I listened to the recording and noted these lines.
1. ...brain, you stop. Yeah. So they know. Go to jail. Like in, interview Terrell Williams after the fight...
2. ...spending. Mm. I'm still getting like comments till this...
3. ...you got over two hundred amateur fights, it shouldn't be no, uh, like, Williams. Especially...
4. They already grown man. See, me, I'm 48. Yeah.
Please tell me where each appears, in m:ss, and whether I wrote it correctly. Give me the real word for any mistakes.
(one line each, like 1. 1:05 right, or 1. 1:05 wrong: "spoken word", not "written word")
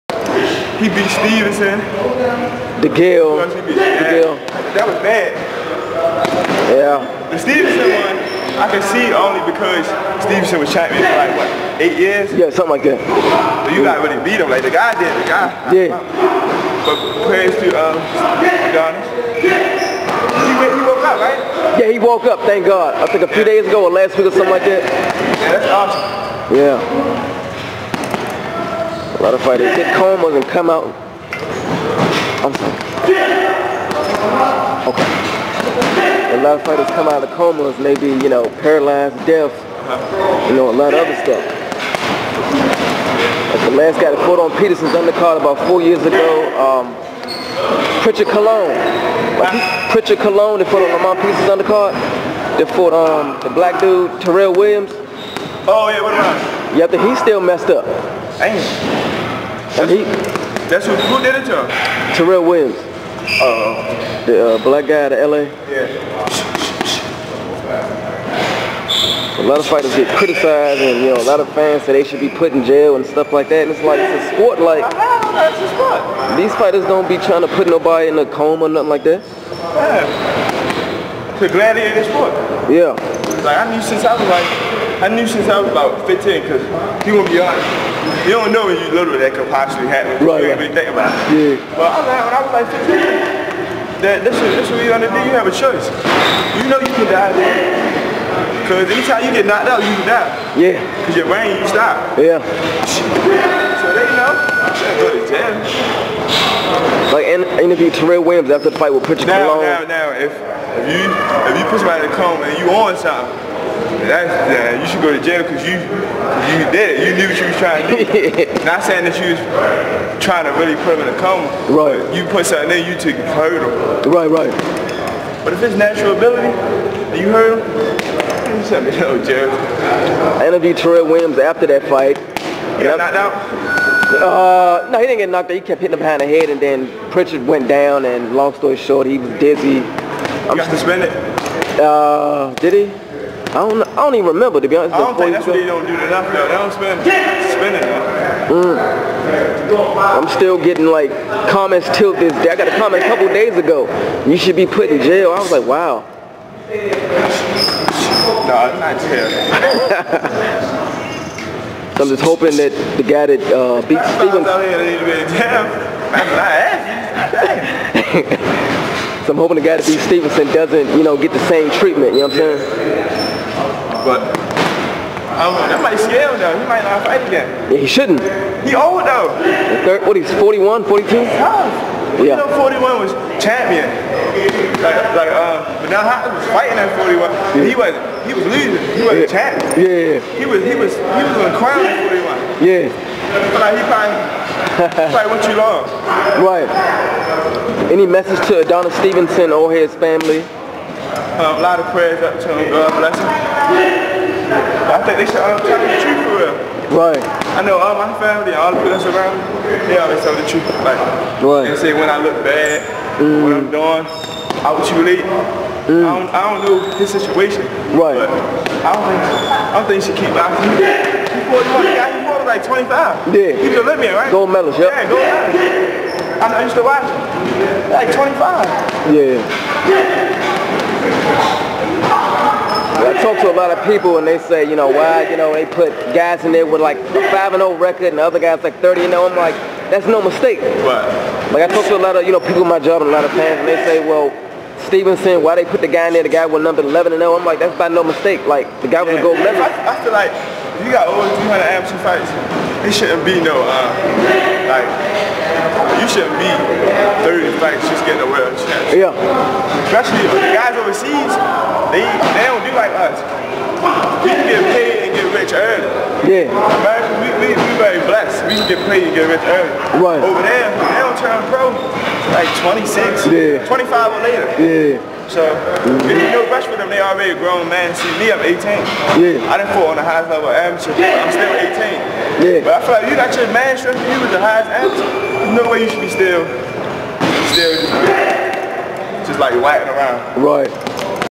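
1. 1:41 right
2. 2:27 right
3. 4:10 wrong: "Yeah", not "Williams"
4. 4:36 wrong: "18", not "48".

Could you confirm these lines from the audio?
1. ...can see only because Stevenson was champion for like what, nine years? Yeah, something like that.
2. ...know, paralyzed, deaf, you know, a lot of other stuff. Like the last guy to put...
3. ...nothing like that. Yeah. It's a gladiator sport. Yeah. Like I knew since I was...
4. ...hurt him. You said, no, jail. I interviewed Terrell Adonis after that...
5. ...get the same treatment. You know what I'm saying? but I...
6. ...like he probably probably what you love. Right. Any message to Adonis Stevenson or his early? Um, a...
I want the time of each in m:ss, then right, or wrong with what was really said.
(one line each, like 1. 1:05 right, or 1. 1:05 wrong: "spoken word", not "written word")
1. 0:08 wrong: "eight", not "nine"
2. 0:38 right
3. 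1:18 right
4. 2:07 wrong: "Williams", not "Adonis"
5. 2:51 right
6. 3:13 wrong: "family", not "early".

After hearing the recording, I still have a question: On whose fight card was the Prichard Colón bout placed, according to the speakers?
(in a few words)
Lamont Peterson.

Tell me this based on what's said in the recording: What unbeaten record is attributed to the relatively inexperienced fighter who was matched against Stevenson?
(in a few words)
11-0.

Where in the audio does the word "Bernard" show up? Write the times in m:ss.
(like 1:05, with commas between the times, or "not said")
3:05.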